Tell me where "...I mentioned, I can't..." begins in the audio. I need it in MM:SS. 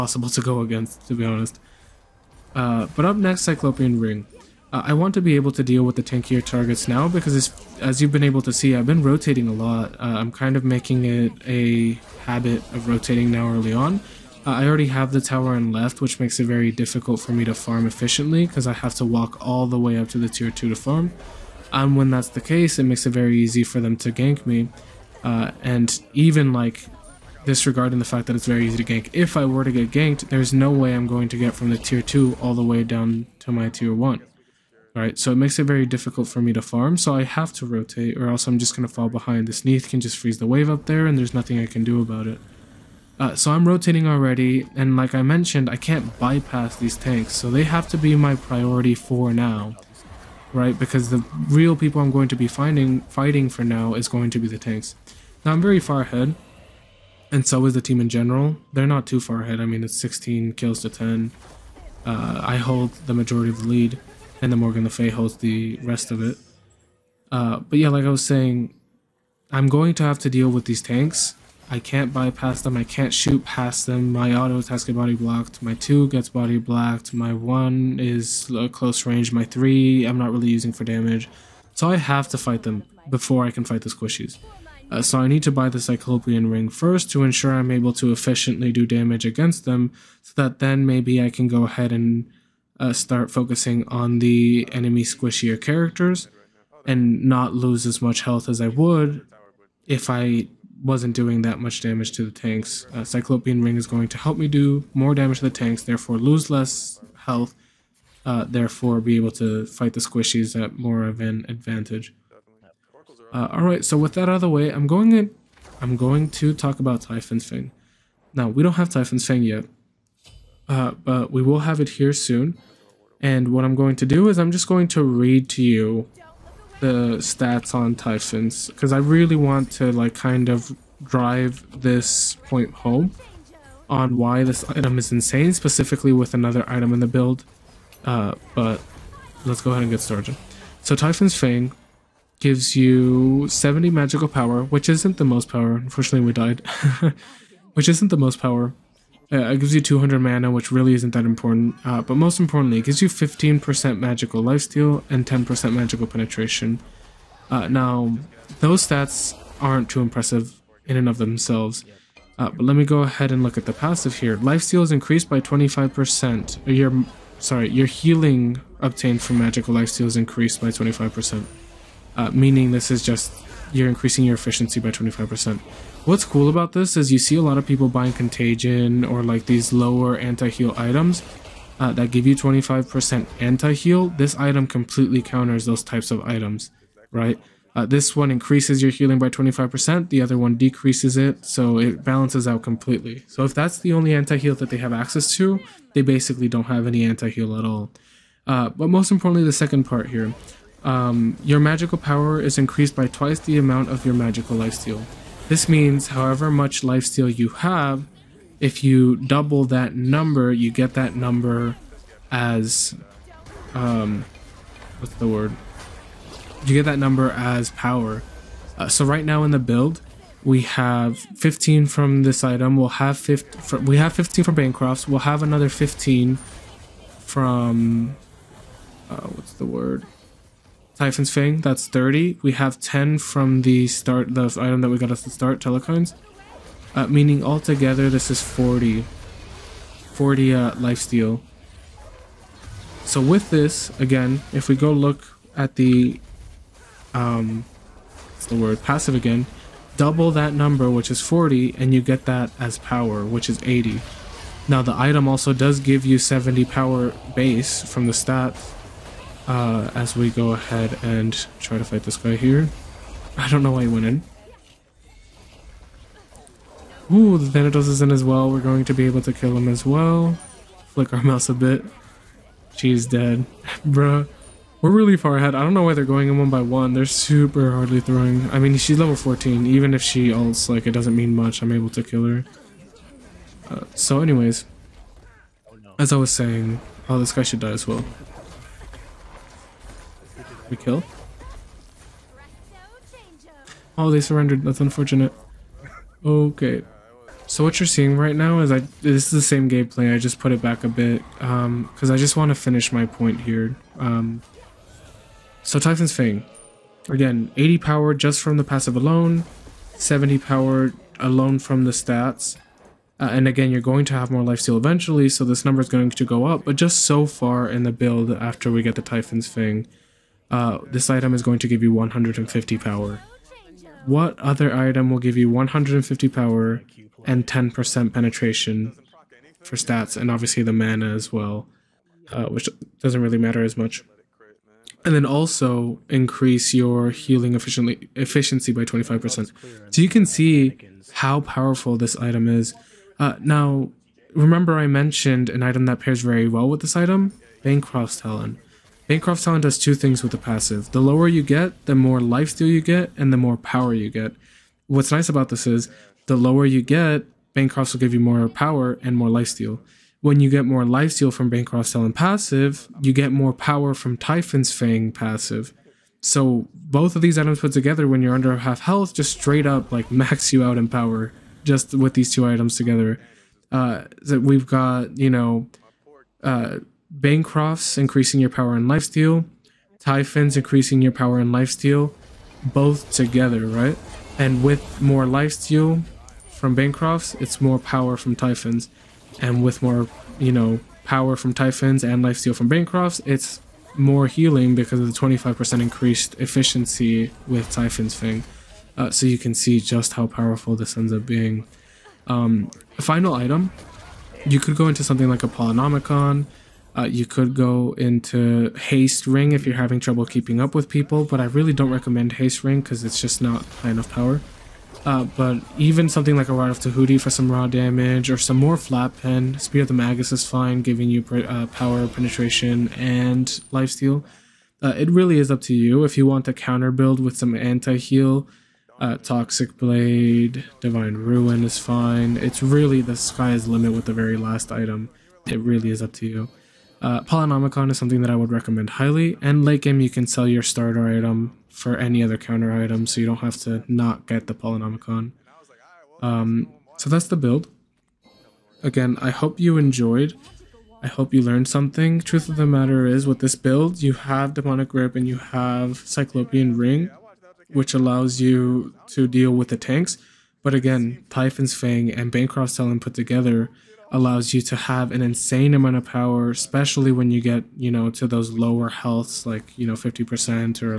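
00:45.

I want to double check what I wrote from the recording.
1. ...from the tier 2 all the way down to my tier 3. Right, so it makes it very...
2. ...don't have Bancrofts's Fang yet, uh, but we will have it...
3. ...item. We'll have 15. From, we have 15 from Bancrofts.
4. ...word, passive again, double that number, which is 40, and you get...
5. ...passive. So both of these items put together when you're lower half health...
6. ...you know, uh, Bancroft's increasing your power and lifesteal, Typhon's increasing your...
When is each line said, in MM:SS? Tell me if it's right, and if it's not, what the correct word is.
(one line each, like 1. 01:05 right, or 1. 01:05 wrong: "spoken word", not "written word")
1. 00:31 wrong: "1", not "3"
2. 01:58 wrong: "Typhon", not "Bancrofts"
3. 03:42 right
4. 04:08 right
5. 06:05 wrong: "under", not "lower"
6. 06:15 right.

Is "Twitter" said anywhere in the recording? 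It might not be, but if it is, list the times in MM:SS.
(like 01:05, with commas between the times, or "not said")
not said.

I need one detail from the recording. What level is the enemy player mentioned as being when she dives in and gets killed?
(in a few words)
14.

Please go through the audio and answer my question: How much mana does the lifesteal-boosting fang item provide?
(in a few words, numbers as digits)
200.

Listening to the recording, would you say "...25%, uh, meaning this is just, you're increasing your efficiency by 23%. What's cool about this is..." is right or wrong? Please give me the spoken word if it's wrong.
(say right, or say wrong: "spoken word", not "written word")
wrong: "25", not "23".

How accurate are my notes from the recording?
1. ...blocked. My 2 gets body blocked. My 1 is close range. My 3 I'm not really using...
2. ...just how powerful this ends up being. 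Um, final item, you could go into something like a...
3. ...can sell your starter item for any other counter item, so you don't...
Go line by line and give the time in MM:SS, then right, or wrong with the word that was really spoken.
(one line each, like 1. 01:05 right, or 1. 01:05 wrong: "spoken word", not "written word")
1. 01:15 right
2. 06:39 right
3. 07:20 right.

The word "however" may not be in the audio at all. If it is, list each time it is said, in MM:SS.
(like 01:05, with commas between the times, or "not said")
03:26.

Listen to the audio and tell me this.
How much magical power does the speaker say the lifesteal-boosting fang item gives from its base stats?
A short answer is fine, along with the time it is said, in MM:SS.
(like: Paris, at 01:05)
70, at 02:23.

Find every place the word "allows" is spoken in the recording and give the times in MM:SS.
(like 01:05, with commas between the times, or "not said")
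07:37, 07:44.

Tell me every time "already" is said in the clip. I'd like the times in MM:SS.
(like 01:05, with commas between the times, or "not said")
00:14, 00:44.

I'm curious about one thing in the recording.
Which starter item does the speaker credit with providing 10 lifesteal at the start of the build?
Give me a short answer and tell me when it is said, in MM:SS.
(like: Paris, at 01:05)
Telkhines, at 03:55.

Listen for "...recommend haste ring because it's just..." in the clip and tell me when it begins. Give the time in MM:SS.
06:51.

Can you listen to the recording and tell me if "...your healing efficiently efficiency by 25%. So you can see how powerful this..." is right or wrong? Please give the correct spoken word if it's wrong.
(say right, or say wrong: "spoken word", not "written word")
right.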